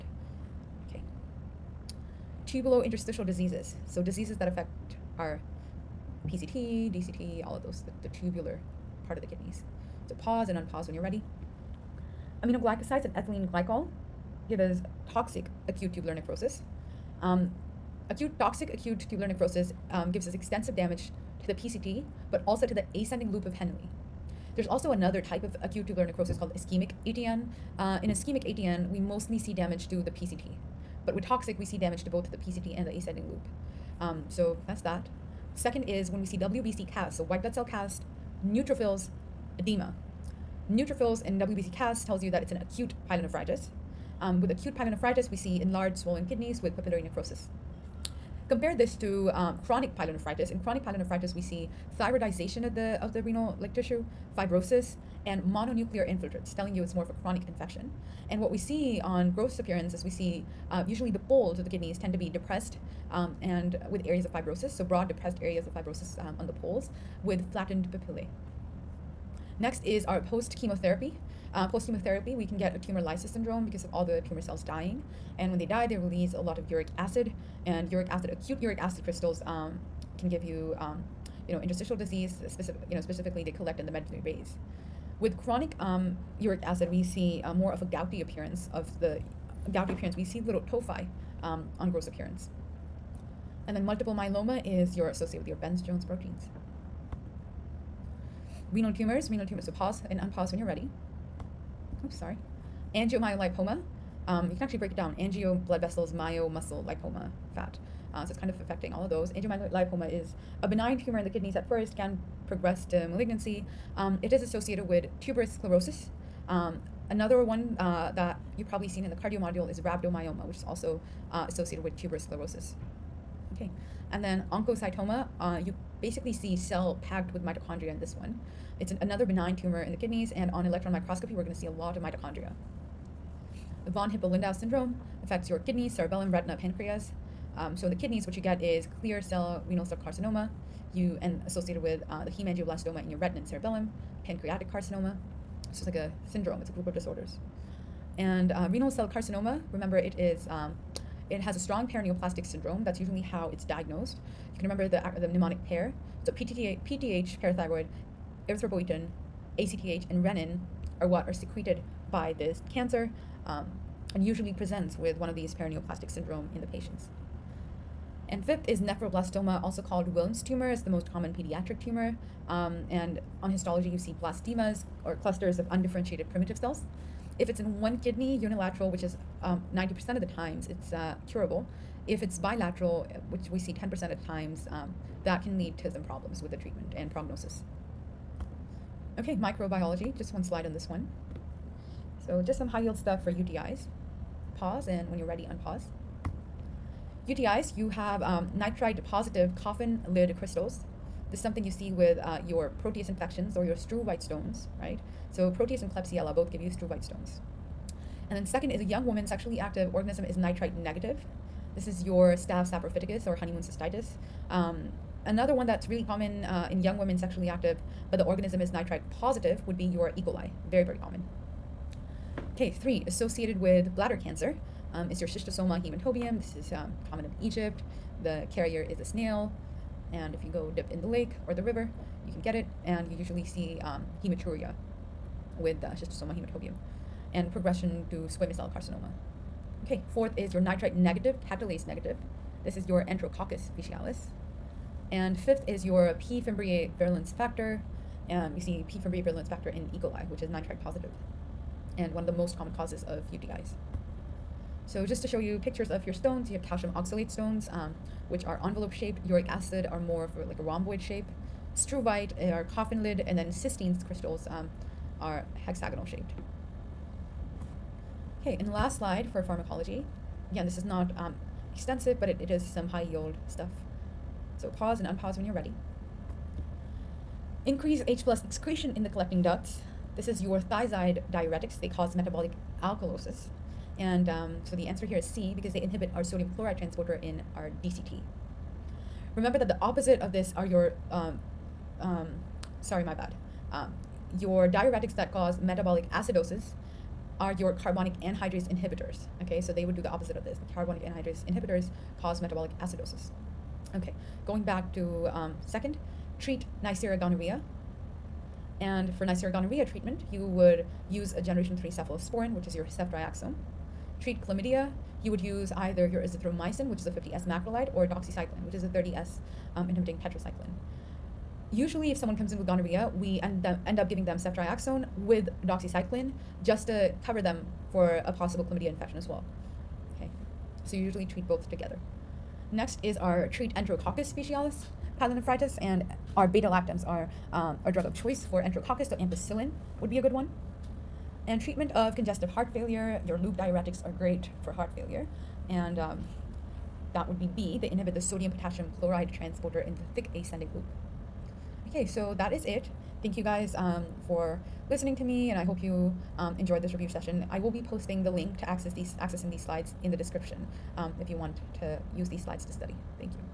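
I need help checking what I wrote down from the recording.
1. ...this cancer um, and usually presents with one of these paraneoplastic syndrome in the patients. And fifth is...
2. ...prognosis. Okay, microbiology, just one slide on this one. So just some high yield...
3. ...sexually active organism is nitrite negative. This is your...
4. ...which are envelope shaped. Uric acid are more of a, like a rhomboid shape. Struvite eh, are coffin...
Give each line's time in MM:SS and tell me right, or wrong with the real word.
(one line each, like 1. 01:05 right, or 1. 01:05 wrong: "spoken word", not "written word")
1. 02:42 right
2. 03:07 right
3. 03:29 right
4. 04:18 right.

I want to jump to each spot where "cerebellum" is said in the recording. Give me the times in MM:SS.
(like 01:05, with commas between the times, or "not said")
02:15, 02:23.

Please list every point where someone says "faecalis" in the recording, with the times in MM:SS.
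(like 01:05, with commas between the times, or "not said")
04:03, 05:34.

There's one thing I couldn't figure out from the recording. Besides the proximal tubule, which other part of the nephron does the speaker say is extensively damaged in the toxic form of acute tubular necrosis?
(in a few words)
ascending loop of Henle.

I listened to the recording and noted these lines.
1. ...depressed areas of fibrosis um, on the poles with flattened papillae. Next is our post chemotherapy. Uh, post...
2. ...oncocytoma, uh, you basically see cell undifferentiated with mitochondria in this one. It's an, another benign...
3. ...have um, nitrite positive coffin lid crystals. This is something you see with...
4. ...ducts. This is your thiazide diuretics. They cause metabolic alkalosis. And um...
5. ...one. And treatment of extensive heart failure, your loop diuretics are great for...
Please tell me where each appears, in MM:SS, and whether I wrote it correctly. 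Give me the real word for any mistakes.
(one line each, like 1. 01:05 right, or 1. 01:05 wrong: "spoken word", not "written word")
1. 01:05 right
2. 02:04 wrong: "packed", not "undifferentiated"
3. 03:17 right
4. 04:39 right
5. 05:40 wrong: "congestive", not "extensive".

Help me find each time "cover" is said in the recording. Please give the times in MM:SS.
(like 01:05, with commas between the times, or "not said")
05:27.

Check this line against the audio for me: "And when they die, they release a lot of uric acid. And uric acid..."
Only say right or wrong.
right.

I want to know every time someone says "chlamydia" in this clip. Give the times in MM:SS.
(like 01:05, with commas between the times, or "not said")
05:14, 05:28.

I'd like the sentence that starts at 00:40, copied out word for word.
Neutrophils and WBC cast tells you that it's an acute pyelonephritis.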